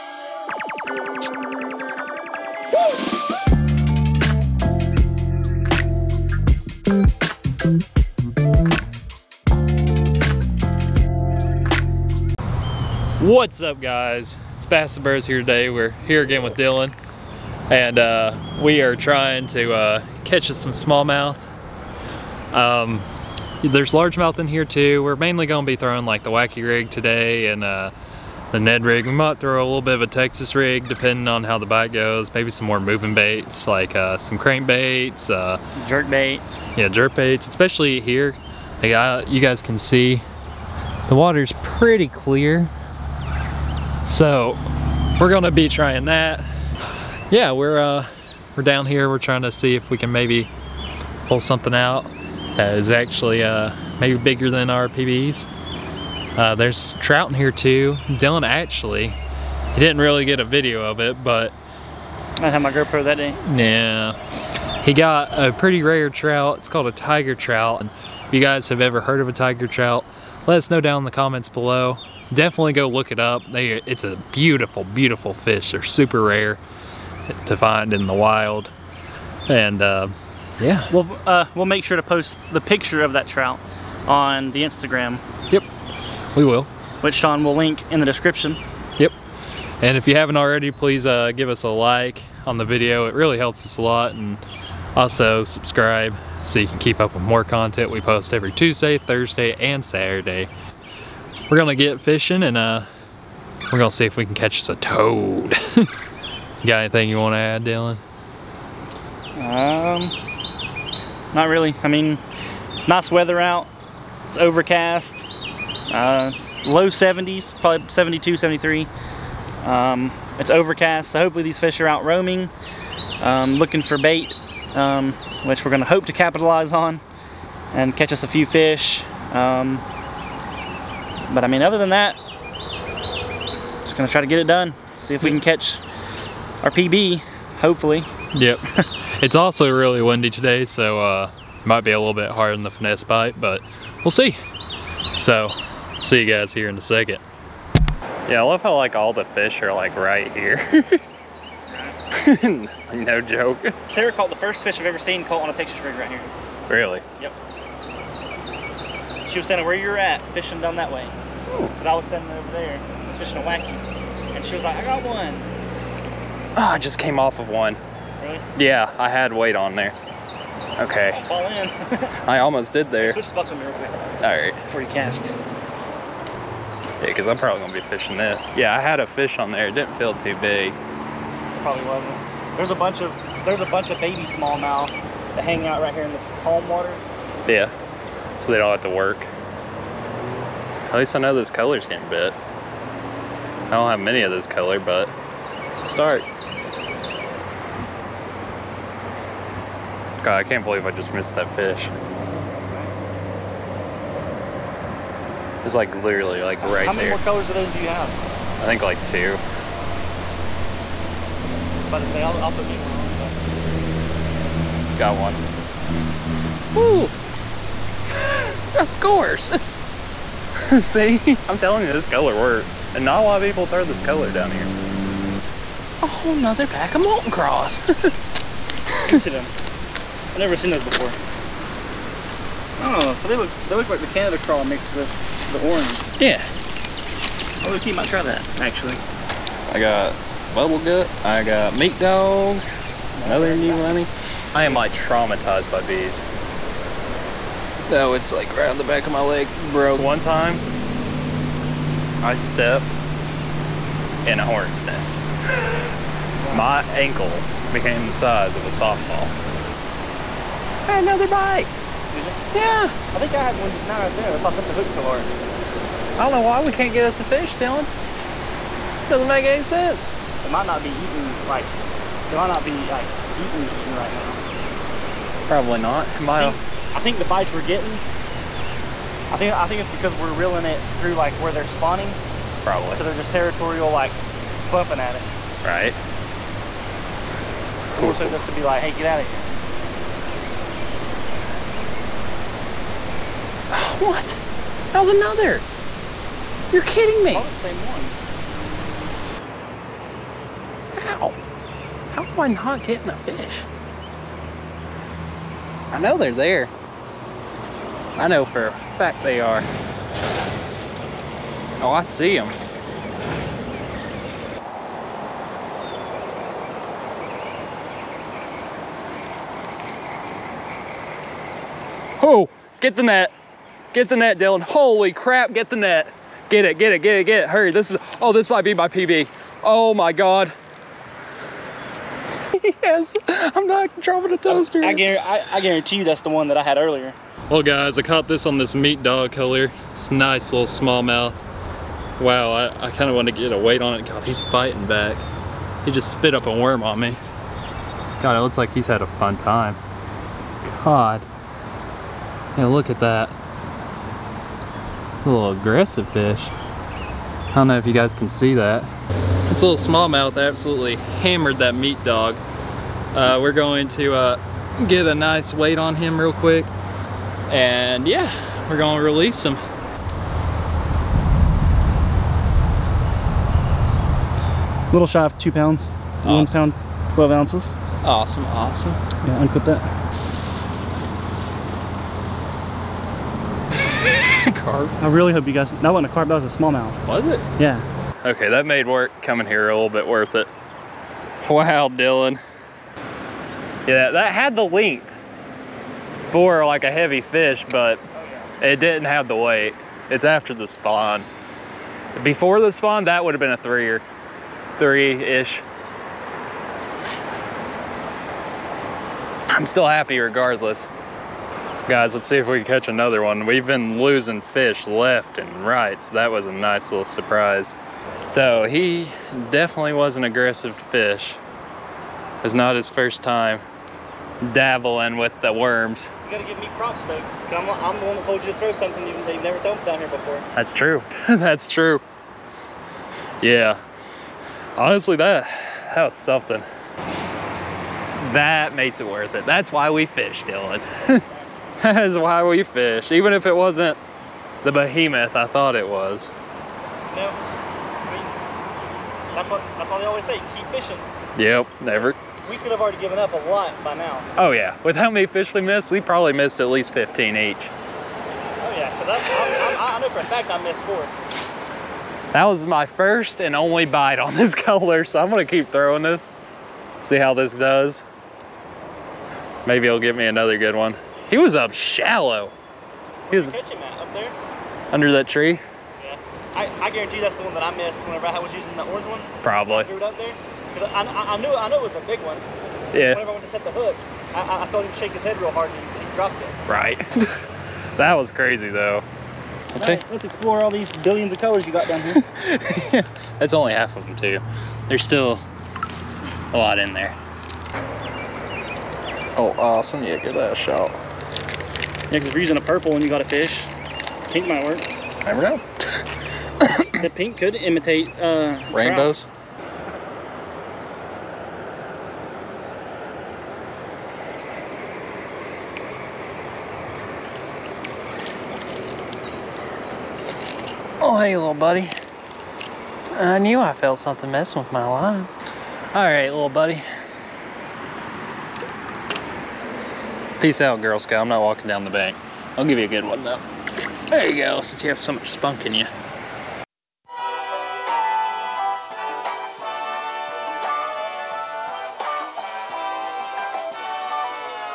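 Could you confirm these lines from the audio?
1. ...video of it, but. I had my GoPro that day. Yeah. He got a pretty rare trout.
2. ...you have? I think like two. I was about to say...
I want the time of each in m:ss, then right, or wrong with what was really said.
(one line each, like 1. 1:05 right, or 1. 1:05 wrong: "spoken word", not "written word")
1. 1:00 right
2. 3:27 right.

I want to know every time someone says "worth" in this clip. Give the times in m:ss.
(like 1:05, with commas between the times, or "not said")
6:30, 7:19.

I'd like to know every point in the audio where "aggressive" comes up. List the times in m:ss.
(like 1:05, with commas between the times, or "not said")
5:55, 7:00.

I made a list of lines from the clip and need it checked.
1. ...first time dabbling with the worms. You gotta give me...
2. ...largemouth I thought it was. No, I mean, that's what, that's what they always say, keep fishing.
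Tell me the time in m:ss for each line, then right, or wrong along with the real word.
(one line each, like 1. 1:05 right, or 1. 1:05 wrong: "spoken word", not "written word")
1. 7:02 right
2. 7:24 wrong: "behemoth", not "largemouth".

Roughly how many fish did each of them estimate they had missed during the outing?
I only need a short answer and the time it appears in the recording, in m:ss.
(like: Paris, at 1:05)
15, at 7:36.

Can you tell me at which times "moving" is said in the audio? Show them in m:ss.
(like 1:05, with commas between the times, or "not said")
0:32.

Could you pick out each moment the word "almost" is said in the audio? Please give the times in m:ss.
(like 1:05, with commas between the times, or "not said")
2:52.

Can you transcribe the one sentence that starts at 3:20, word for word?
God, I can't believe I just missed that fish.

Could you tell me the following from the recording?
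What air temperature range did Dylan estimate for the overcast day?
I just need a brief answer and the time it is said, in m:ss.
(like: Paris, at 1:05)
Low 70s, at 1:56.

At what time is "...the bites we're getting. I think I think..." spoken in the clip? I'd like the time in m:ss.
4:37.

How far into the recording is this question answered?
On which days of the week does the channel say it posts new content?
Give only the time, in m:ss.
1:38.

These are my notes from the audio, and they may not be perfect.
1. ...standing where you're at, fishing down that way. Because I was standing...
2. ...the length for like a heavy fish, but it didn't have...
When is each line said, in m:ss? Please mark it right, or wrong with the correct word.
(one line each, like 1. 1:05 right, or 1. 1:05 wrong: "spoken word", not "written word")
1. 2:39 right
2. 6:34 right.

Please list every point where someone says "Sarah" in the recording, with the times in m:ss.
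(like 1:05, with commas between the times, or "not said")
2:33.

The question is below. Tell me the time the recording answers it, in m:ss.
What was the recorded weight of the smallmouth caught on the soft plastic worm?
6:16.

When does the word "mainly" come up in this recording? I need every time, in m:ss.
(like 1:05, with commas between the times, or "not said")
0:25.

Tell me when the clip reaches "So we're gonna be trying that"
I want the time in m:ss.
0:44.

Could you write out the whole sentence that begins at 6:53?
We've been losing fish left and right, so that was a nice little surprise.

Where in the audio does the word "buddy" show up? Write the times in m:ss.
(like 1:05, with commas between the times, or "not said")
8:41, 8:46.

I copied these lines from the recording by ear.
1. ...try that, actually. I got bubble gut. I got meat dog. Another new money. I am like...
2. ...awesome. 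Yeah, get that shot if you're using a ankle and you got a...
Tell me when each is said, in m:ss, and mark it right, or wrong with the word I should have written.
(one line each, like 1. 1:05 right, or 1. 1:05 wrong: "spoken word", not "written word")
1. 3:58 right
2. 8:19 wrong: "purple", not "ankle".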